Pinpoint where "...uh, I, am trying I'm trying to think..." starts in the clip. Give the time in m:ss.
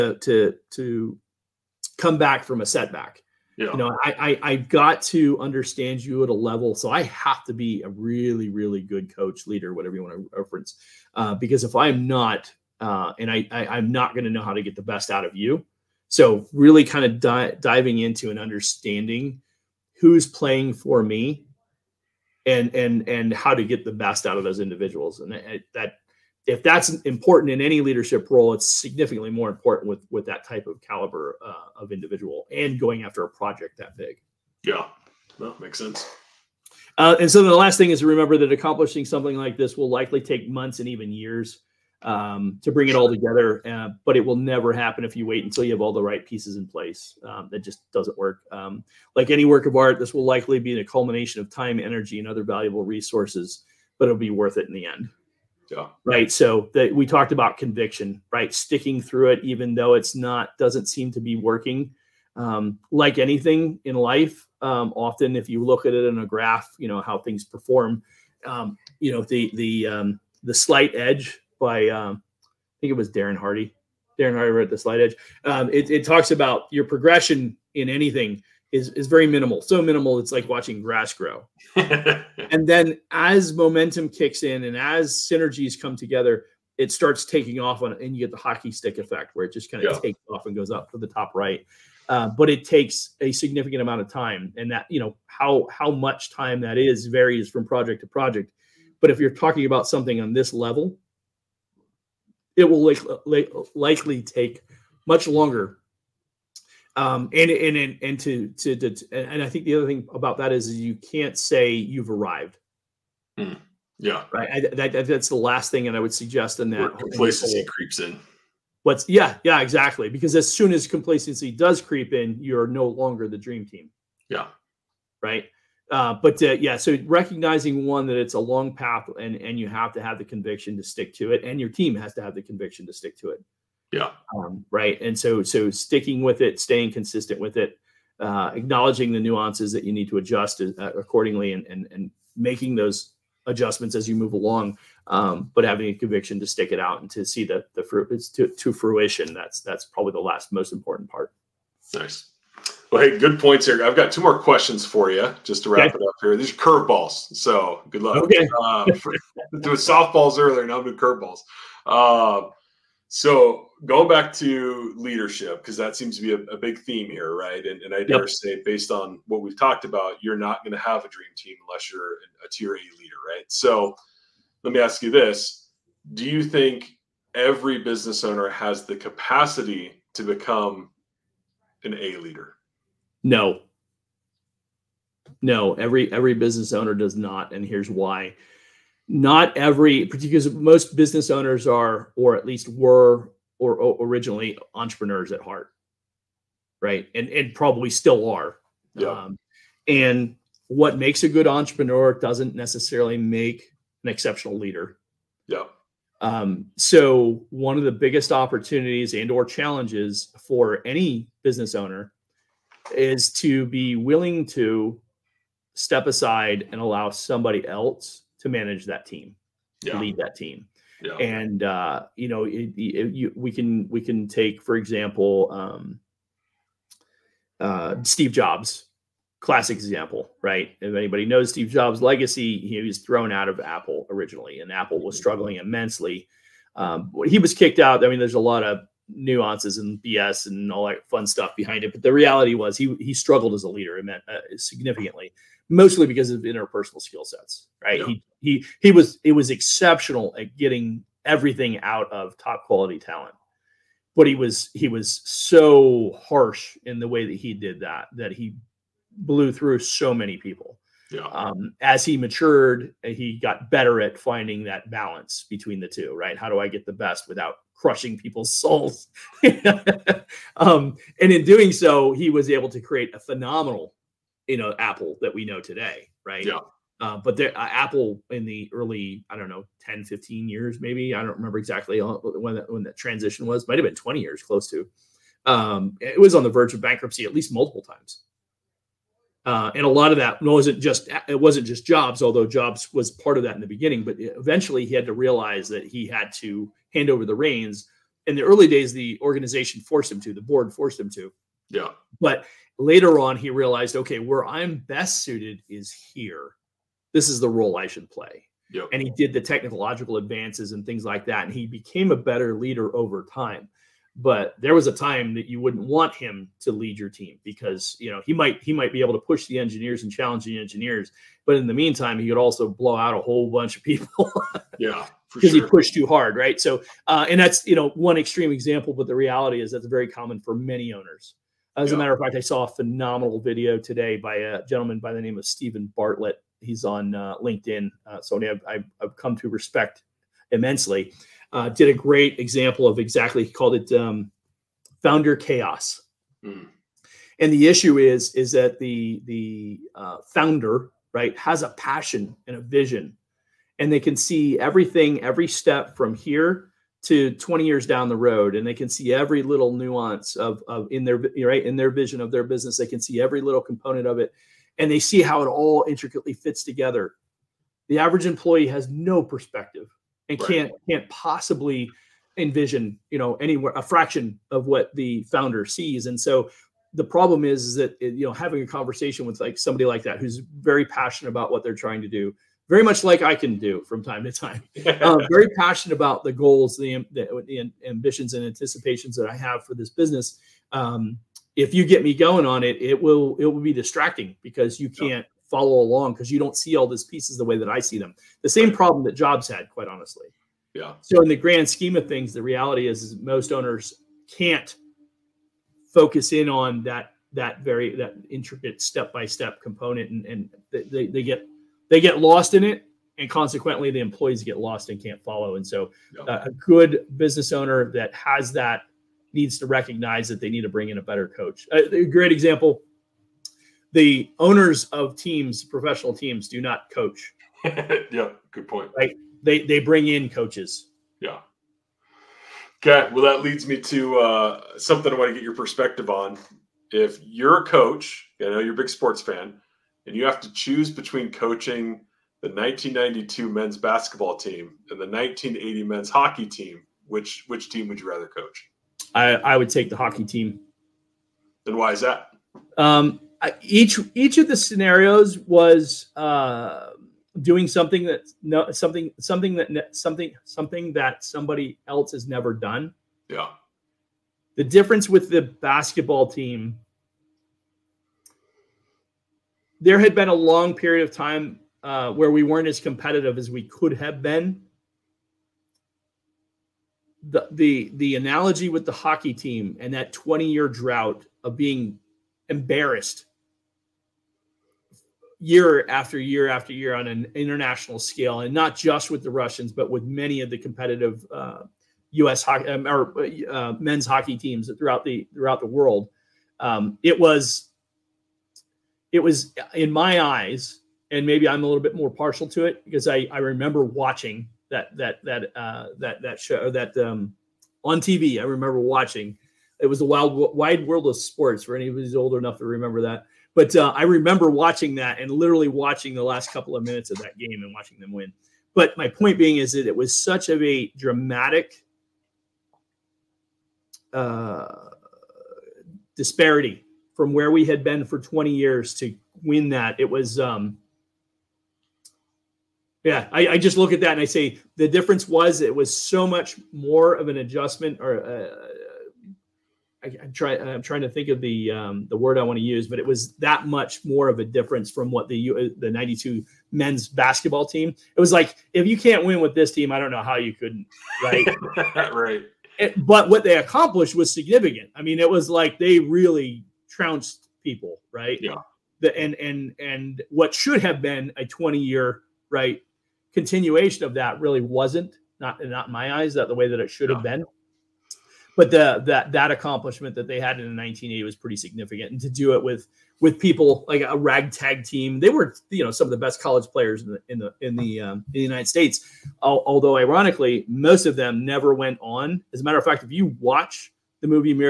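8:58.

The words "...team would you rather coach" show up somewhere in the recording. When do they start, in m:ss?
7:27.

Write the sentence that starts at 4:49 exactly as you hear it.
Uh, and a lot of that wasn't just it wasn't just Jobs, although Jobs was part of that in the beginning.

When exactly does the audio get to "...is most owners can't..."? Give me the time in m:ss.
6:43.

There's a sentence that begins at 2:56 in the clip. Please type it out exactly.
Do you think every business owner has the capacity to become an A leader?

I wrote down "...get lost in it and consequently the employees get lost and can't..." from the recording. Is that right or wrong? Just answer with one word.
right.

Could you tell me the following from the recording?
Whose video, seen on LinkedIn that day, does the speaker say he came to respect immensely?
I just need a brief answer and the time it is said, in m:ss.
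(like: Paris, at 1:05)
Steven Bartlett, at 5:35.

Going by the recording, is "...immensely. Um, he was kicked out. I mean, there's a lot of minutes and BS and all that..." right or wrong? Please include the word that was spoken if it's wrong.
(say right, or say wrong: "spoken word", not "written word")
wrong: "nuances", not "minutes".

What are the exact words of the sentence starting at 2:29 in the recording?
That's that's probably the last most important part.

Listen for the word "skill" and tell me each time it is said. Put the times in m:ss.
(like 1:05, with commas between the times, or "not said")
4:07.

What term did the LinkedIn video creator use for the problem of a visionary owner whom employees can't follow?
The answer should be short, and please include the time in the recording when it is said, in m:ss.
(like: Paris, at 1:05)
Founder chaos, at 5:45.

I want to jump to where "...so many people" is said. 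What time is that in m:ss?
4:19.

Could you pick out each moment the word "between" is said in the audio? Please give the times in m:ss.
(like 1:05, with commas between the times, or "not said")
4:25, 7:20.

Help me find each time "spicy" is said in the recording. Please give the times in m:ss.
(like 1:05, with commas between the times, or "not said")
not said.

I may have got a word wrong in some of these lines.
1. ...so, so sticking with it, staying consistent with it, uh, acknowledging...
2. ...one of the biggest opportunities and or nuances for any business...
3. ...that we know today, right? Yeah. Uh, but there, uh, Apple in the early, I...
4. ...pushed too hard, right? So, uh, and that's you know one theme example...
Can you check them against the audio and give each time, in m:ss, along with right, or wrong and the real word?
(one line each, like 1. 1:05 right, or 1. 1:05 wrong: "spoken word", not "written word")
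1. 2:15 right
2. 3:27 wrong: "challenges", not "nuances"
3. 4:35 right
4. 5:25 wrong: "extreme", not "theme".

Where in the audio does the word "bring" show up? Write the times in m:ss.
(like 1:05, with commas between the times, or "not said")
0:42, 7:00, 7:09.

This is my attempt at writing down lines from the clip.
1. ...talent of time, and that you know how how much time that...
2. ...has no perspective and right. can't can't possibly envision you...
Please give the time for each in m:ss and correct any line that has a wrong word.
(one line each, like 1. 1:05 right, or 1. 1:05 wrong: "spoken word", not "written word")
1. 1:33 wrong: "amount", not "talent"
2. 6:08 right.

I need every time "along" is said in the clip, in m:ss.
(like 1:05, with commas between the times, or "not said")
2:24, 6:35.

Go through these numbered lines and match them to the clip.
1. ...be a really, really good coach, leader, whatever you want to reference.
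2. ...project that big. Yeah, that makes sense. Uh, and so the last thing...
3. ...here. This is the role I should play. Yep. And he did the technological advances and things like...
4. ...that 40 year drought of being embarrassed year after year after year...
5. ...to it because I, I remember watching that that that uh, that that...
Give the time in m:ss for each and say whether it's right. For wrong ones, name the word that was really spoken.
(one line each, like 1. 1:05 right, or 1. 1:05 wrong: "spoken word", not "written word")
1. 0:07 right
2. 0:33 right
3. 5:05 right
4. 7:59 wrong: "20", not "40"
5. 8:22 right.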